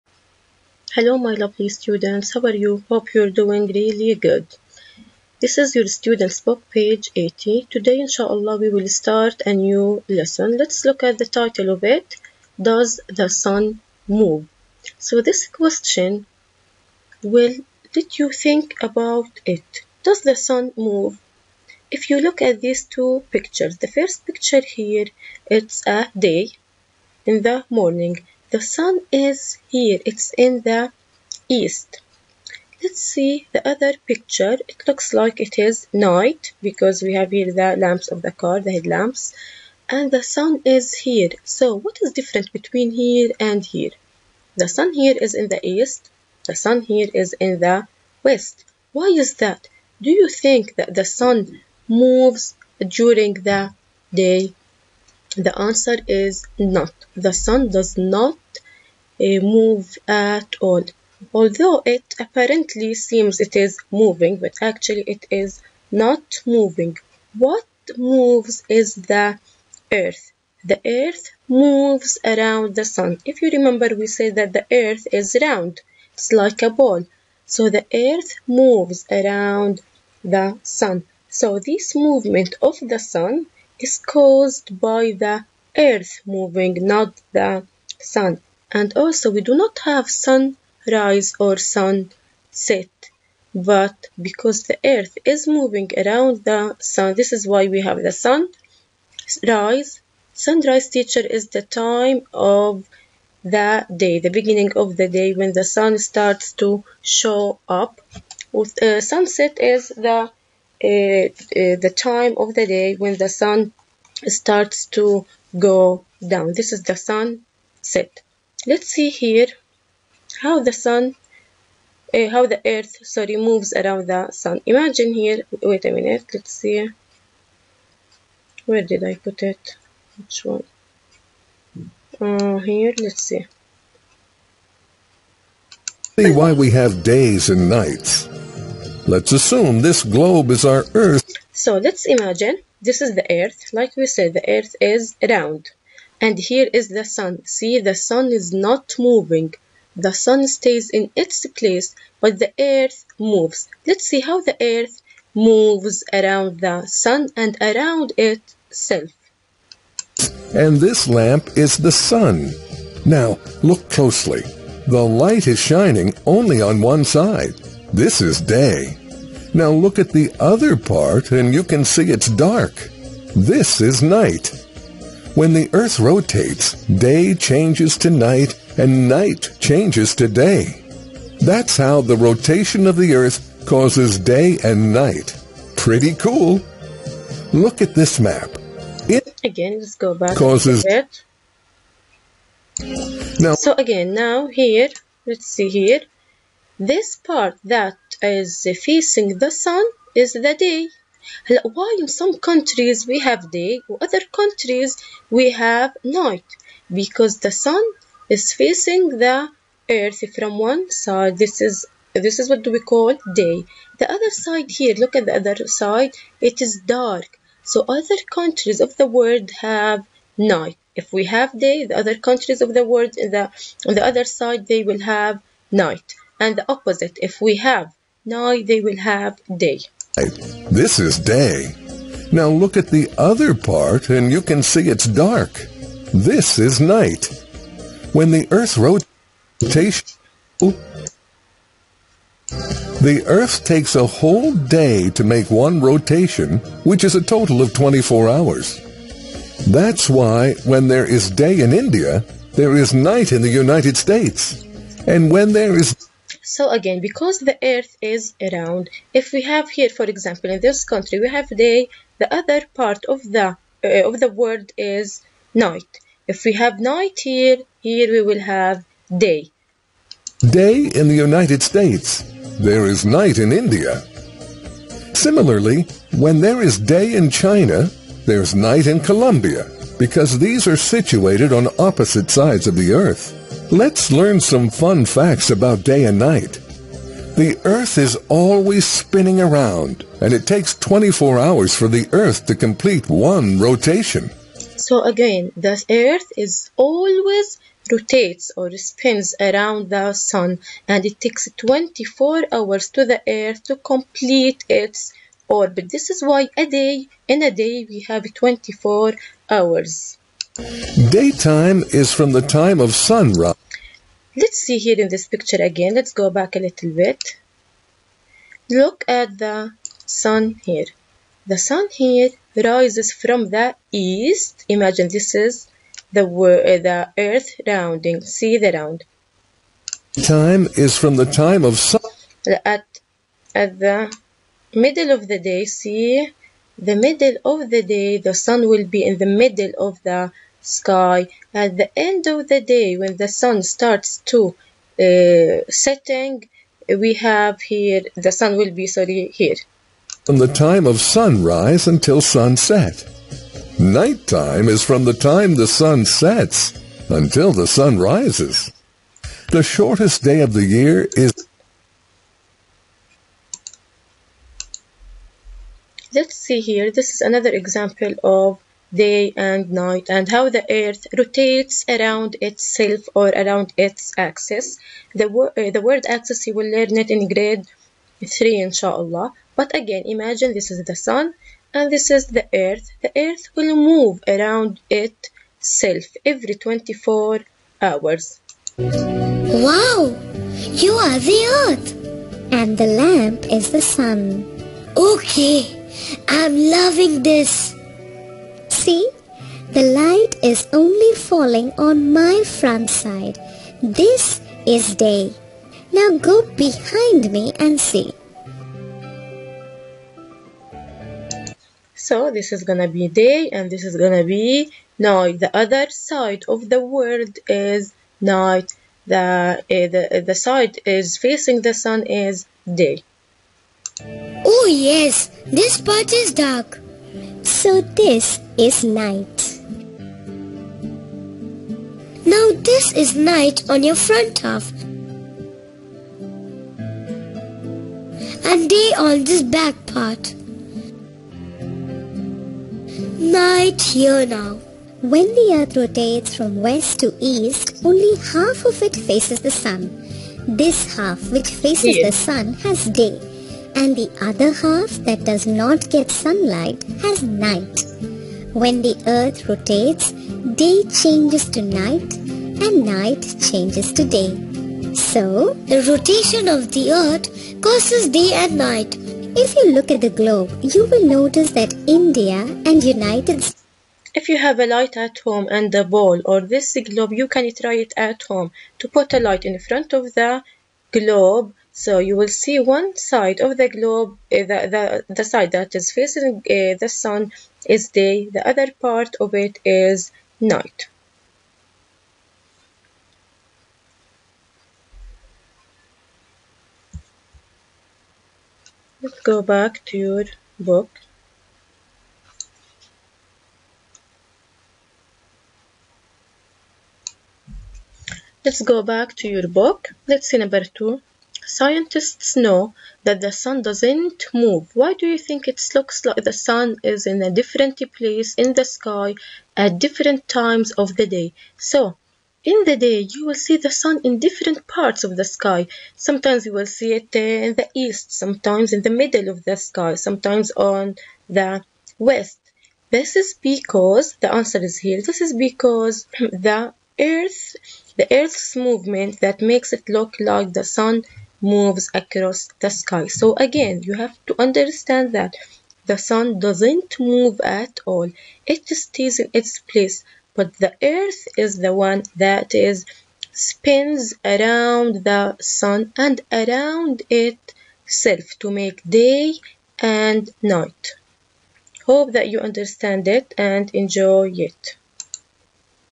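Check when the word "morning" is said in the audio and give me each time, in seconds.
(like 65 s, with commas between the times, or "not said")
27 s.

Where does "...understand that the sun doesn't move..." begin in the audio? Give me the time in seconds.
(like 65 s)
544 s.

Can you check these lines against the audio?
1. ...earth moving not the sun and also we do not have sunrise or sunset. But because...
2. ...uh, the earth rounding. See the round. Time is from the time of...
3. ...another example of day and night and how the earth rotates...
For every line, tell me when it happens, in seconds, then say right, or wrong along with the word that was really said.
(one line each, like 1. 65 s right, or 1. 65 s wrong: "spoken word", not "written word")
1. 85 s right
2. 326 s right
3. 367 s right.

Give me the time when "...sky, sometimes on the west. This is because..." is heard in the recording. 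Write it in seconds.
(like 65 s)
529 s.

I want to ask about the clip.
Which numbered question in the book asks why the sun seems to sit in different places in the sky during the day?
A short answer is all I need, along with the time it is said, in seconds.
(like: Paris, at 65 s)
Number 2, at 510 s.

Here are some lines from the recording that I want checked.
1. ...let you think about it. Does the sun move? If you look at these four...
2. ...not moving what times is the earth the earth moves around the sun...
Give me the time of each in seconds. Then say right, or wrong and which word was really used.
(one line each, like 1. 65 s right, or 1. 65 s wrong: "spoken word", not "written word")
1. 17 s wrong: "two", not "four"
2. 65 s wrong: "moves", not "times".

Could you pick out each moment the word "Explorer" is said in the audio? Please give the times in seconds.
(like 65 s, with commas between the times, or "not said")
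not said.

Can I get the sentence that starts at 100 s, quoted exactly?
Sunrise teacher is the time of the day, the beginning of the day when the sun starts to show up.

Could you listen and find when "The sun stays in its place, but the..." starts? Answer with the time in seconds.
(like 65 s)
149 s.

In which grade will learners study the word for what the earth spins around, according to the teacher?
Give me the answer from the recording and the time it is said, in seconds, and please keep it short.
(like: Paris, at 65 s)
Grade 3, at 377 s.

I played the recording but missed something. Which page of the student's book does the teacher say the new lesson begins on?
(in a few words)
80.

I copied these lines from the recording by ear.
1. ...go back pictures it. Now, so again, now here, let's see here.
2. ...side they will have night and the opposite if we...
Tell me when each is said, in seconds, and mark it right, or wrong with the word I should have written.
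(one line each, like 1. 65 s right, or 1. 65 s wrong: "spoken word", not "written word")
1. 189 s wrong: "causes", not "pictures"
2. 224 s right.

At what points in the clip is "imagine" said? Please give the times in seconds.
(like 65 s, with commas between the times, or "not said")
124 s, 142 s, 324 s, 380 s.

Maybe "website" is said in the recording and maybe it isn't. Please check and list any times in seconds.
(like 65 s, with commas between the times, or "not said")
not said.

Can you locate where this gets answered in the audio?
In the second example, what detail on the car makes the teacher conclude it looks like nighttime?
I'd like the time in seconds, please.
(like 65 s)
38 s.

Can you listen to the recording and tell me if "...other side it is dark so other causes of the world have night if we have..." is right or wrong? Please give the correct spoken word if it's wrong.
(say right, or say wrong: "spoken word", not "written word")
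wrong: "countries", not "causes".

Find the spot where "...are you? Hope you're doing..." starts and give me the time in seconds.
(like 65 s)
2 s.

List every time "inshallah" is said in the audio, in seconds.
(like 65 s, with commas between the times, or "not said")
8 s, 378 s.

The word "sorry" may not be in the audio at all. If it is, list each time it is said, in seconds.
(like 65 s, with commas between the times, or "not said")
123 s, 348 s.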